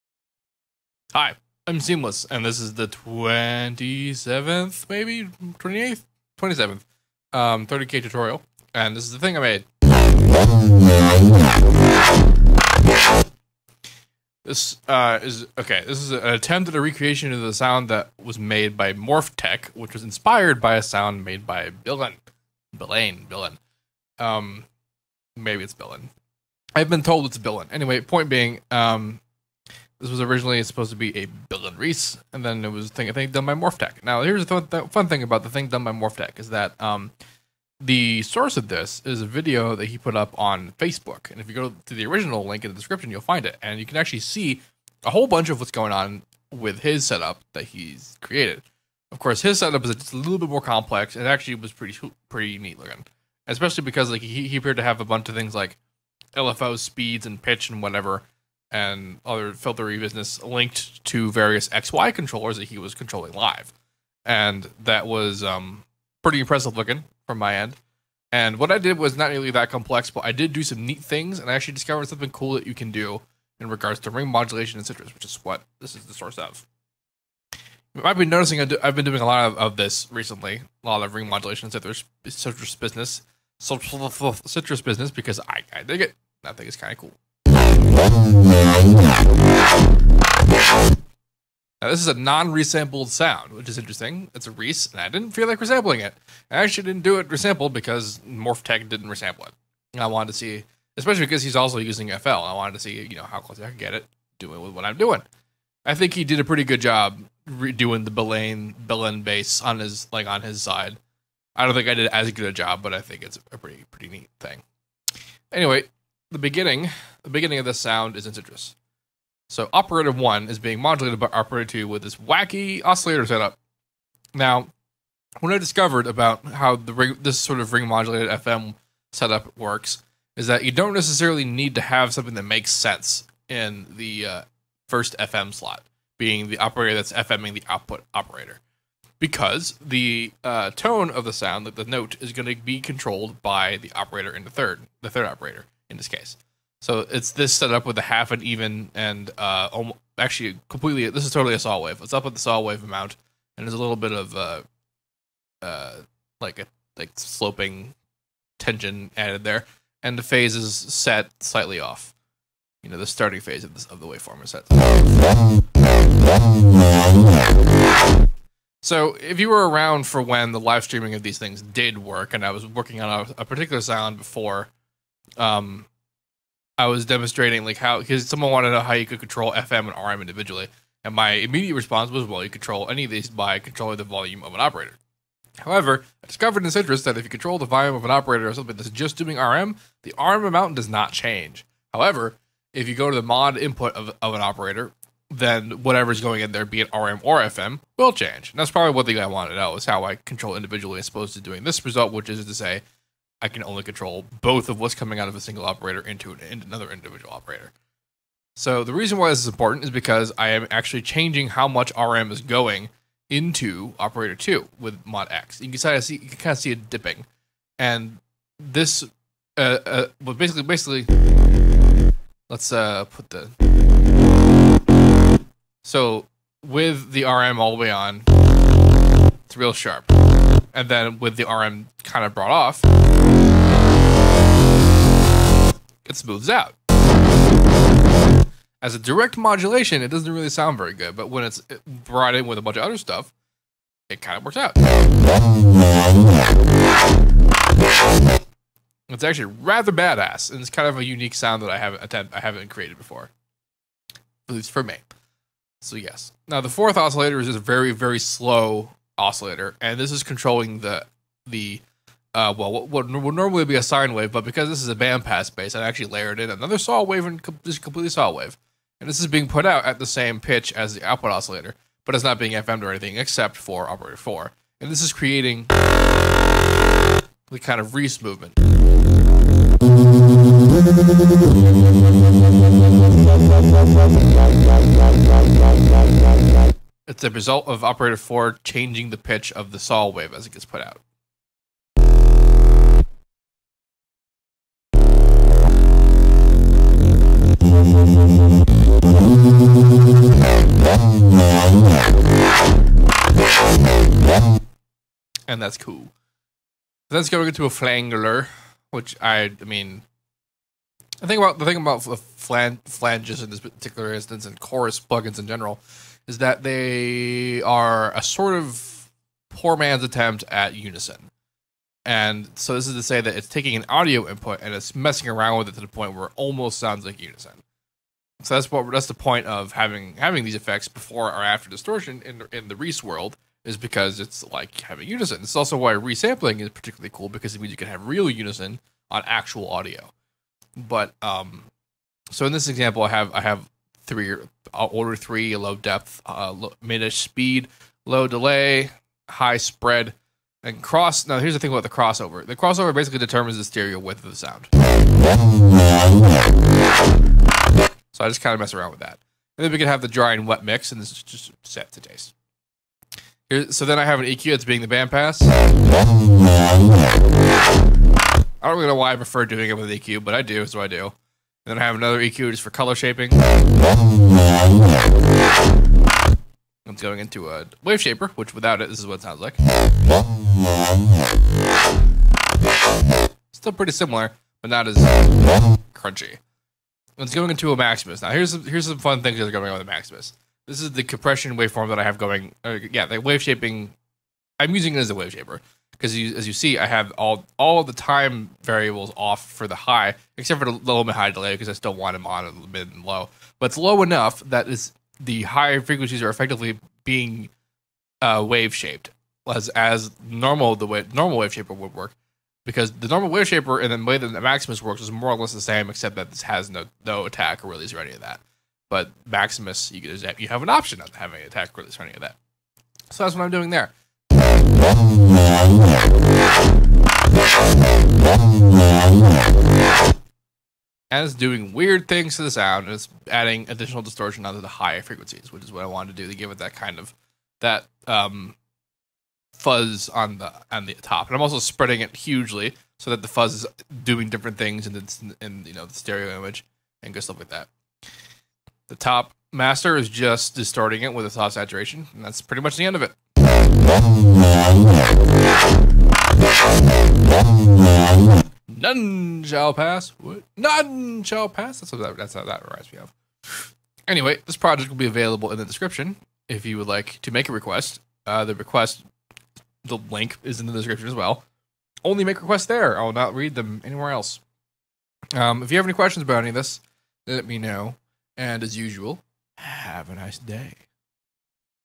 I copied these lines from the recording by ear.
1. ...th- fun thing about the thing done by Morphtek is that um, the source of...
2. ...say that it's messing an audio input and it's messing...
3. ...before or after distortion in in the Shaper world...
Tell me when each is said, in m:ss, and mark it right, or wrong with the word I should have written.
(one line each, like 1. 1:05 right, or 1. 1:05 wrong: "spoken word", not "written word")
1. 0:34 right
2. 5:23 wrong: "taking", not "messing"
3. 5:30 wrong: "Reese", not "Shaper".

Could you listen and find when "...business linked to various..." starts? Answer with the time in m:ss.
0:59.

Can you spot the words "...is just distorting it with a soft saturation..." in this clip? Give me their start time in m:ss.
7:29.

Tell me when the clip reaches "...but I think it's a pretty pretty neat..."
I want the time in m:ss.
1:52.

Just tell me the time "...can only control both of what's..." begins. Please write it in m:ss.
3:23.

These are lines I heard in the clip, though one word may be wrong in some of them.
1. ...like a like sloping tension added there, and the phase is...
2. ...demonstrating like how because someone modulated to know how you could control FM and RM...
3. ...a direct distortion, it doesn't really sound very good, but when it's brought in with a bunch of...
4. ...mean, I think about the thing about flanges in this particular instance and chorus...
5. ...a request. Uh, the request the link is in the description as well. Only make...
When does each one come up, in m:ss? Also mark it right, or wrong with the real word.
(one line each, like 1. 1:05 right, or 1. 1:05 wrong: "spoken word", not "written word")
1. 2:36 right
2. 2:57 wrong: "wanted", not "modulated"
3. 3:58 wrong: "modulation", not "distortion"
4. 5:09 right
5. 7:47 right.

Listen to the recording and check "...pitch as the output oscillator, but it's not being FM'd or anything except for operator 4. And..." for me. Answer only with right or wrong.
right.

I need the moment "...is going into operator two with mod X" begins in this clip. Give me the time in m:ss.
3:32.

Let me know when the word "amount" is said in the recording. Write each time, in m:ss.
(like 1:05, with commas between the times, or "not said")
2:32, 3:10.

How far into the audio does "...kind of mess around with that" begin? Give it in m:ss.
5:58.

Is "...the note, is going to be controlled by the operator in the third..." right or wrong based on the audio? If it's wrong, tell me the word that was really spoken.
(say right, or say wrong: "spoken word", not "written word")
right.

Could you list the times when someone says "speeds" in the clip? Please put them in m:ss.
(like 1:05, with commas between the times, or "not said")
0:56, 5:47.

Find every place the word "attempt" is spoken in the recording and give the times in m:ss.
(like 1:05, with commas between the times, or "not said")
0:16, 5:20.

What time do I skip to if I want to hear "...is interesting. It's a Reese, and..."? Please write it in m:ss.
1:33.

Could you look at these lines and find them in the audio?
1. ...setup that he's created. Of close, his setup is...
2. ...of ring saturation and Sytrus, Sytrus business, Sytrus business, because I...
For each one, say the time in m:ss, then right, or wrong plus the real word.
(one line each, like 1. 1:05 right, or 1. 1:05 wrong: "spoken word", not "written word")
1. 0:47 wrong: "course", not "close"
2. 1:21 wrong: "modulation", not "saturation".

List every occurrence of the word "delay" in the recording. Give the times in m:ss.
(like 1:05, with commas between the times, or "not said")
5:48, 6:41.